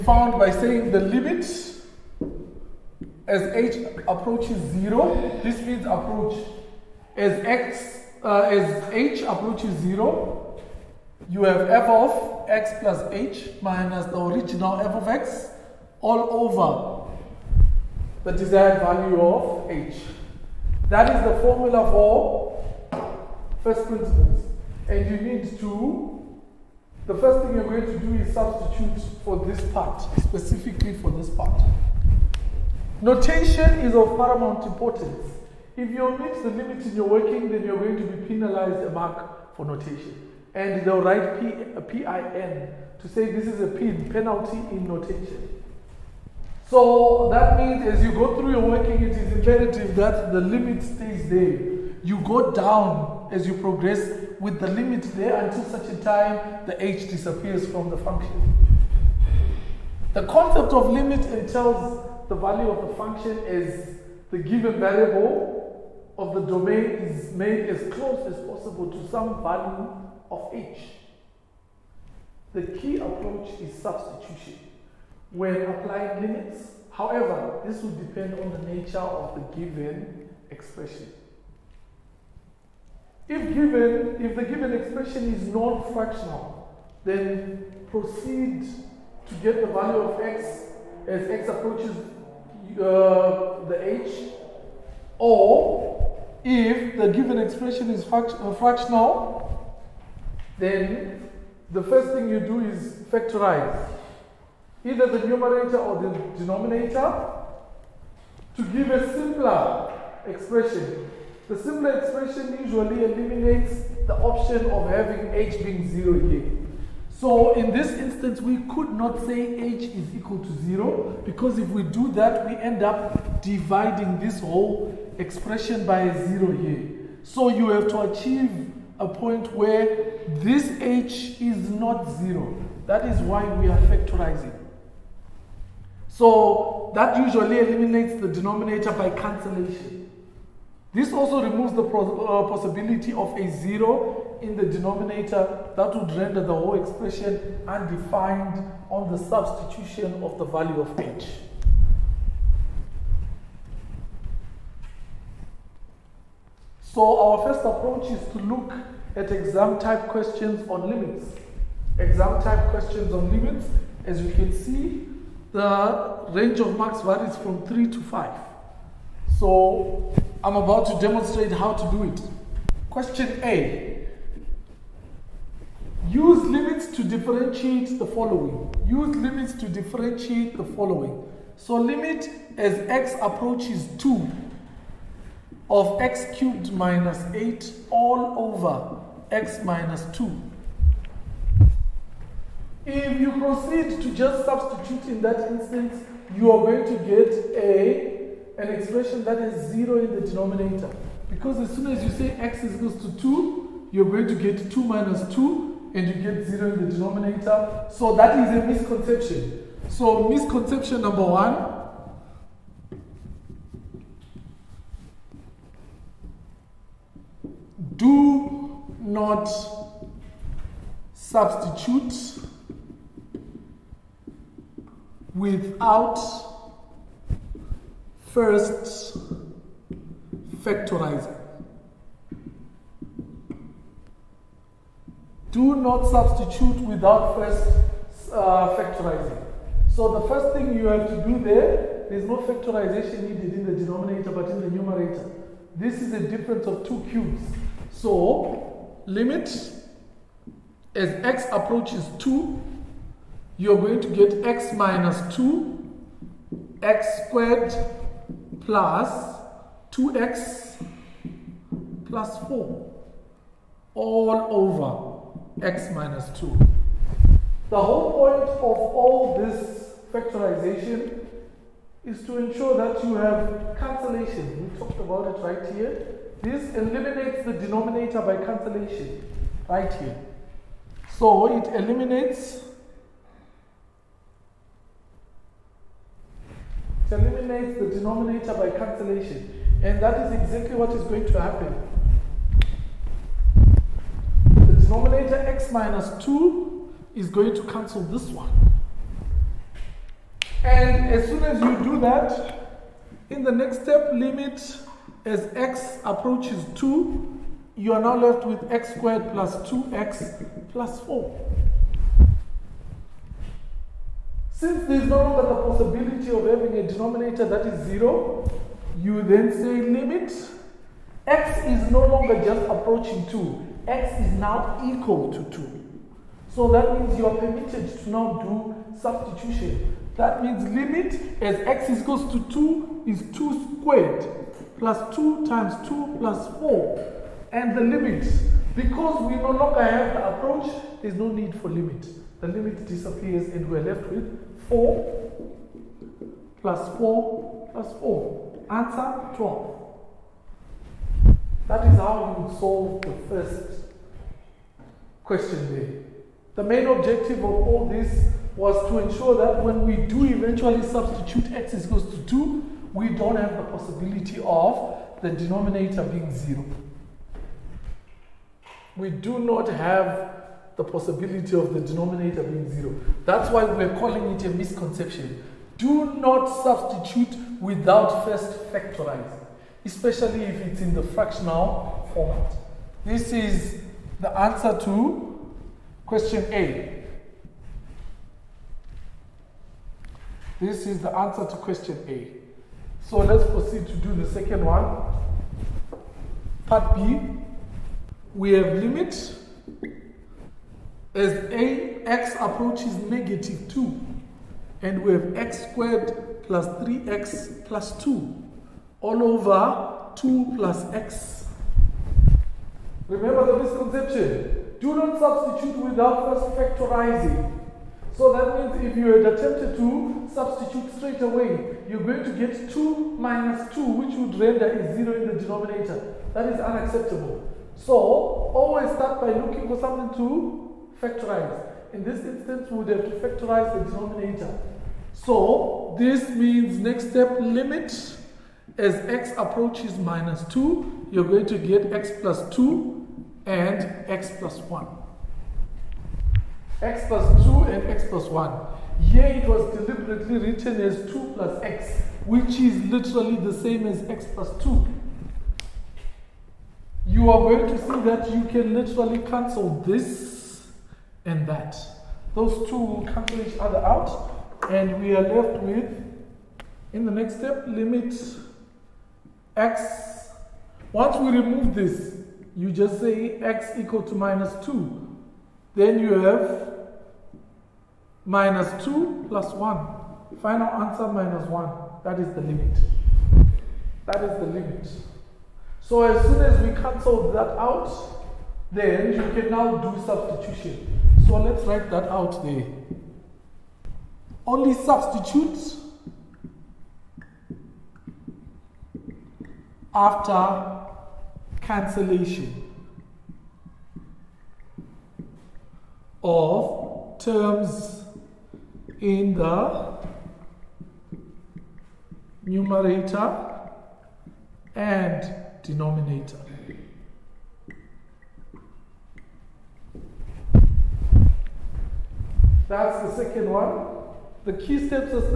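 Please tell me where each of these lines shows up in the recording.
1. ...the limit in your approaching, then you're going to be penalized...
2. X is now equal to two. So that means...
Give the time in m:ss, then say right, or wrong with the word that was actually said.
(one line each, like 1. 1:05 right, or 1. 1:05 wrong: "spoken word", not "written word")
1. 0:36 wrong: "working", not "approaching"
2. 5:23 right.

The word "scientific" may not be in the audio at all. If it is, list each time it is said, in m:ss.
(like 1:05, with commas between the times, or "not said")
not said.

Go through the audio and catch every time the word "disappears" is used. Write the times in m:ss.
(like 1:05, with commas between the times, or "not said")
0:57, 5:42.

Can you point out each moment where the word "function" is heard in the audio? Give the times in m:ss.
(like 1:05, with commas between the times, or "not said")
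0:57, 1:02.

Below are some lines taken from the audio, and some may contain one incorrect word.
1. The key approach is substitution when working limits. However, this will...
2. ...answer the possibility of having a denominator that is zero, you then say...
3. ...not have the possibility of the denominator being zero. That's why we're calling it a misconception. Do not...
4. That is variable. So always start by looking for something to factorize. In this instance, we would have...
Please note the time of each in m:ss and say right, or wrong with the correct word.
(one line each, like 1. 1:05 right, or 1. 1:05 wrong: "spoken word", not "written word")
1. 1:12 wrong: "applying", not "working"
2. 5:15 wrong: "longer", not "answer"
3. 6:09 right
4. 7:06 wrong: "unacceptable", not "variable".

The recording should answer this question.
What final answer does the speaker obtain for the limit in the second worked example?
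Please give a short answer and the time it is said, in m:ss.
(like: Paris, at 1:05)
-1, at 8:01.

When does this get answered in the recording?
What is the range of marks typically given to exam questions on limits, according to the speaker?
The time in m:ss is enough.
2:47.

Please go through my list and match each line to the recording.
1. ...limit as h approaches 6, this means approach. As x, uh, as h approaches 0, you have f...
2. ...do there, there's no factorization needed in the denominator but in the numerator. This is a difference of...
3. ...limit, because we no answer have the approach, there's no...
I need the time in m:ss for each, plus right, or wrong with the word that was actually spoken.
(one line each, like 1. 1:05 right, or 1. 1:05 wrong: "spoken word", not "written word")
1. 0:00 wrong: "0", not "6"
2. 4:01 right
3. 5:37 wrong: "longer", not "answer".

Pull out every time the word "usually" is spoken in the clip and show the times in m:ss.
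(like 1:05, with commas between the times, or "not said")
1:52, 2:17.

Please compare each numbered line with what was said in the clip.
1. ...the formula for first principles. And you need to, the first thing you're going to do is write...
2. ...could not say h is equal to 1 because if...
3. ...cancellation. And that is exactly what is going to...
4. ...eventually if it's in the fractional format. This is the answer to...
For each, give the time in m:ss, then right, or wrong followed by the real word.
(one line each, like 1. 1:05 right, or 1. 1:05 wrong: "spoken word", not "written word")
1. 0:21 wrong: "substitute", not "write"
2. 1:58 wrong: "0", not "1"
3. 4:48 right
4. 6:19 wrong: "especially", not "eventually".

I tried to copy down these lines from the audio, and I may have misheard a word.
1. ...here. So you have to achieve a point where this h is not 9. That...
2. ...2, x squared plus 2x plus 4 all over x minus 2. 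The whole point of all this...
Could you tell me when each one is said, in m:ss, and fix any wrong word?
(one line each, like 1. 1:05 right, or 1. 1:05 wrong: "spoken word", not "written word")
1. 2:06 wrong: "0", not "9"
2. 4:15 right.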